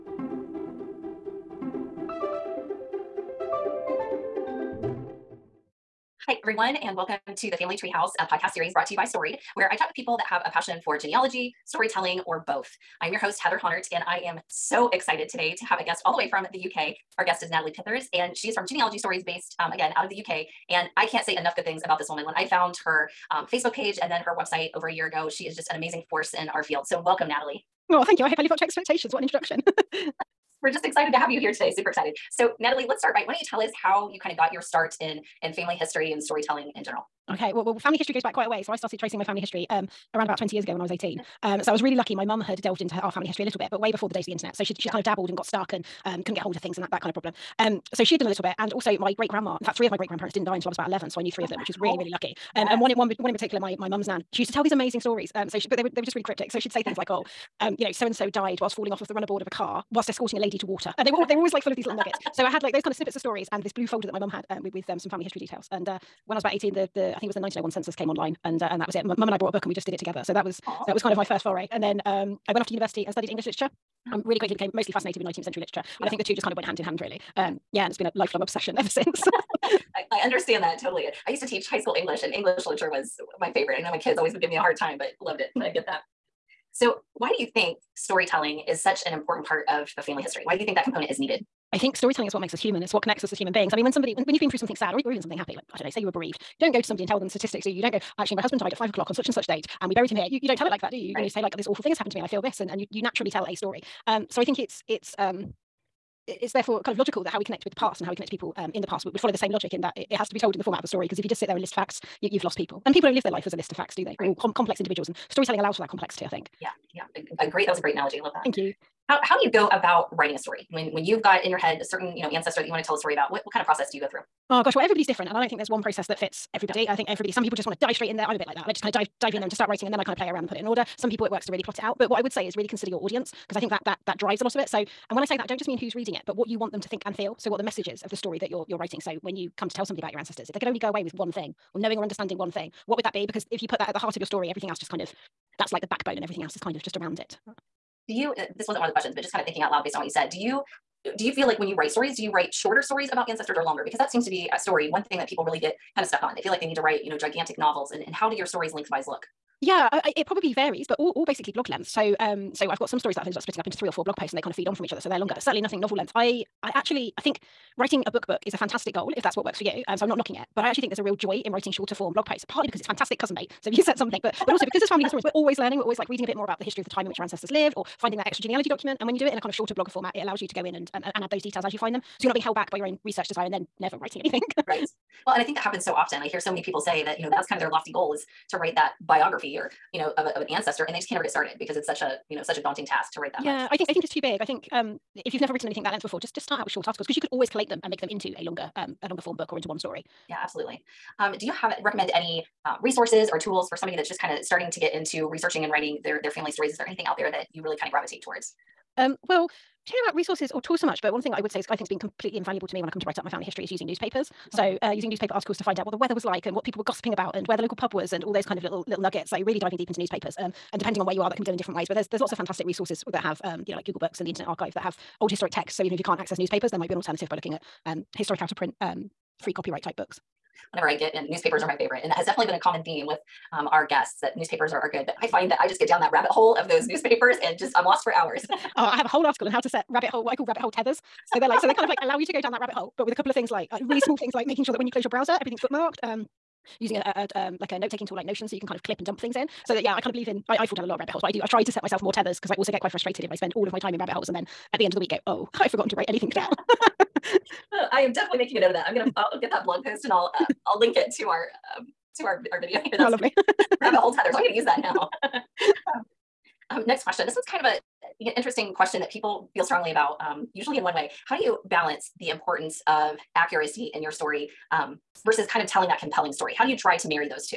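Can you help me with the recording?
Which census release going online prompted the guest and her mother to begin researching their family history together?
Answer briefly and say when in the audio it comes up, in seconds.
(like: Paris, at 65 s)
1901 census, at 67 s.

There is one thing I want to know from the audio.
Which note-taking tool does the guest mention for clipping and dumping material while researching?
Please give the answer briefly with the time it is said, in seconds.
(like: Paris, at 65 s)
Notion, at 248 s.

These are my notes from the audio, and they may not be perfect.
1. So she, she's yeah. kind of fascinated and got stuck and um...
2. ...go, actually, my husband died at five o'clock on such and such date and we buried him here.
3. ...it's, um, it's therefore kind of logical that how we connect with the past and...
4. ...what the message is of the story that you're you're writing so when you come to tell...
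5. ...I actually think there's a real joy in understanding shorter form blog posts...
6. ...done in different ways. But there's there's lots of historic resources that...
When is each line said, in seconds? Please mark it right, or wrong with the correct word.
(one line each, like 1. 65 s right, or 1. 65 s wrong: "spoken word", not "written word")
1. 44 s wrong: "dabbled", not "fascinated"
2. 97 s right
3. 104 s right
4. 137 s right
5. 170 s wrong: "writing", not "understanding"
6. 221 s wrong: "fantastic", not "historic".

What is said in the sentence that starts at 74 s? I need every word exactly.
um, really quickly became mostly fascinated with 19th century literature, yeah.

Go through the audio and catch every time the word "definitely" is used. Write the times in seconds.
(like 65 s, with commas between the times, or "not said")
232 s, 258 s.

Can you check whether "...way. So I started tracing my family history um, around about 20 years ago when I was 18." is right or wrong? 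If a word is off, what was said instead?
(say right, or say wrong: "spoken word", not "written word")
right.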